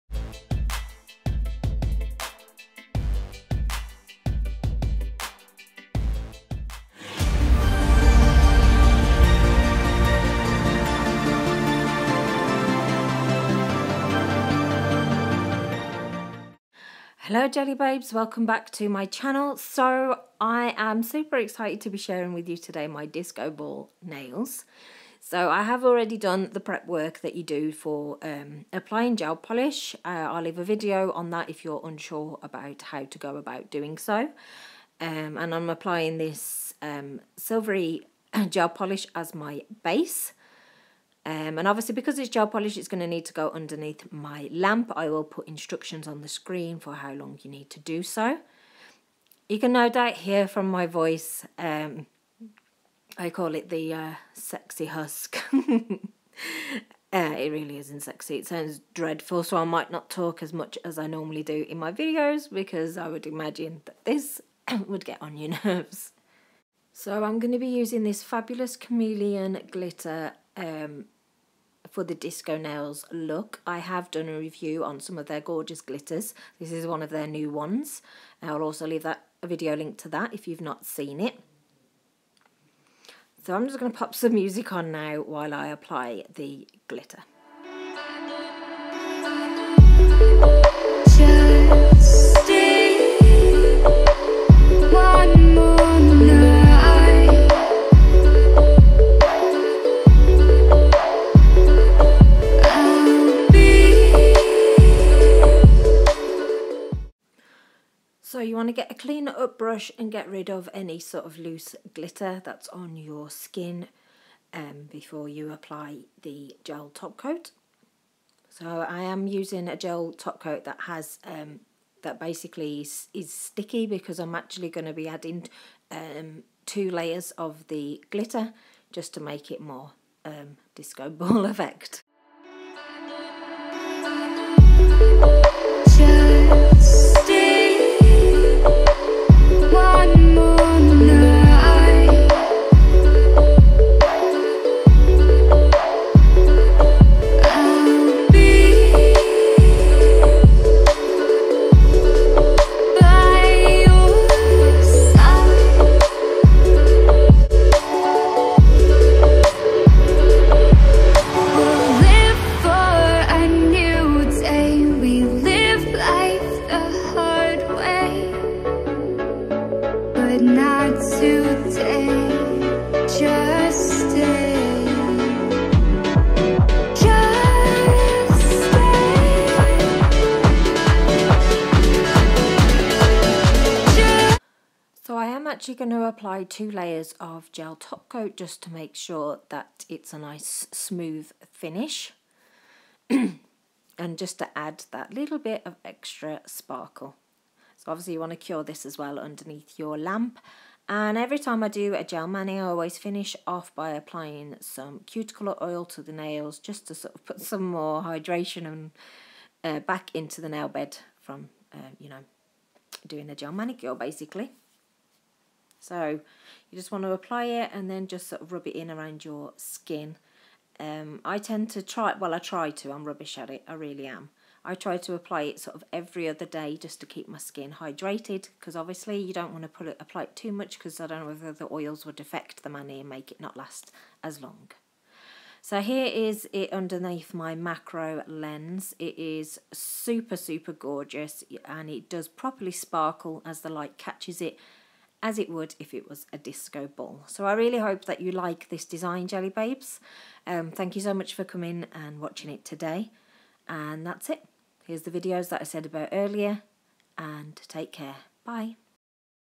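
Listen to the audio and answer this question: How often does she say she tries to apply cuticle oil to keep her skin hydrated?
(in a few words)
every other day.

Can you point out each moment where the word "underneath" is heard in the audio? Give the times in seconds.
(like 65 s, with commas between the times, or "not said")
43 s, 199 s, 236 s.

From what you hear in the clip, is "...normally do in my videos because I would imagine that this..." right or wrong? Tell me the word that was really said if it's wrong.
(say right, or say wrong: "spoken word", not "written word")
right.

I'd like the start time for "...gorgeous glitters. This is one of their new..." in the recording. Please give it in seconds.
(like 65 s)
75 s.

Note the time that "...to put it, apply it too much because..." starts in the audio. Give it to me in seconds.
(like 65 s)
229 s.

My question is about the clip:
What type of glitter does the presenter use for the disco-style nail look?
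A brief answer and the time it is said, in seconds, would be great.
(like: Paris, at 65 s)
chameleon glitter, at 68 s.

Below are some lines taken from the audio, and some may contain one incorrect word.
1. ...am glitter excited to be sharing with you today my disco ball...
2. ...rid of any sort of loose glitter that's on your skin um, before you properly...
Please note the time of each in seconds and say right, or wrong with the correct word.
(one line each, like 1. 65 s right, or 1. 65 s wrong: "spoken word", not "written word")
1. 20 s wrong: "super", not "glitter"
2. 110 s wrong: "apply", not "properly".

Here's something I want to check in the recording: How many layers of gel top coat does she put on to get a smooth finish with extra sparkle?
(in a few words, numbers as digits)
2.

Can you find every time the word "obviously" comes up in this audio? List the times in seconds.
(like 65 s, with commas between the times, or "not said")
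41 s, 197 s, 228 s.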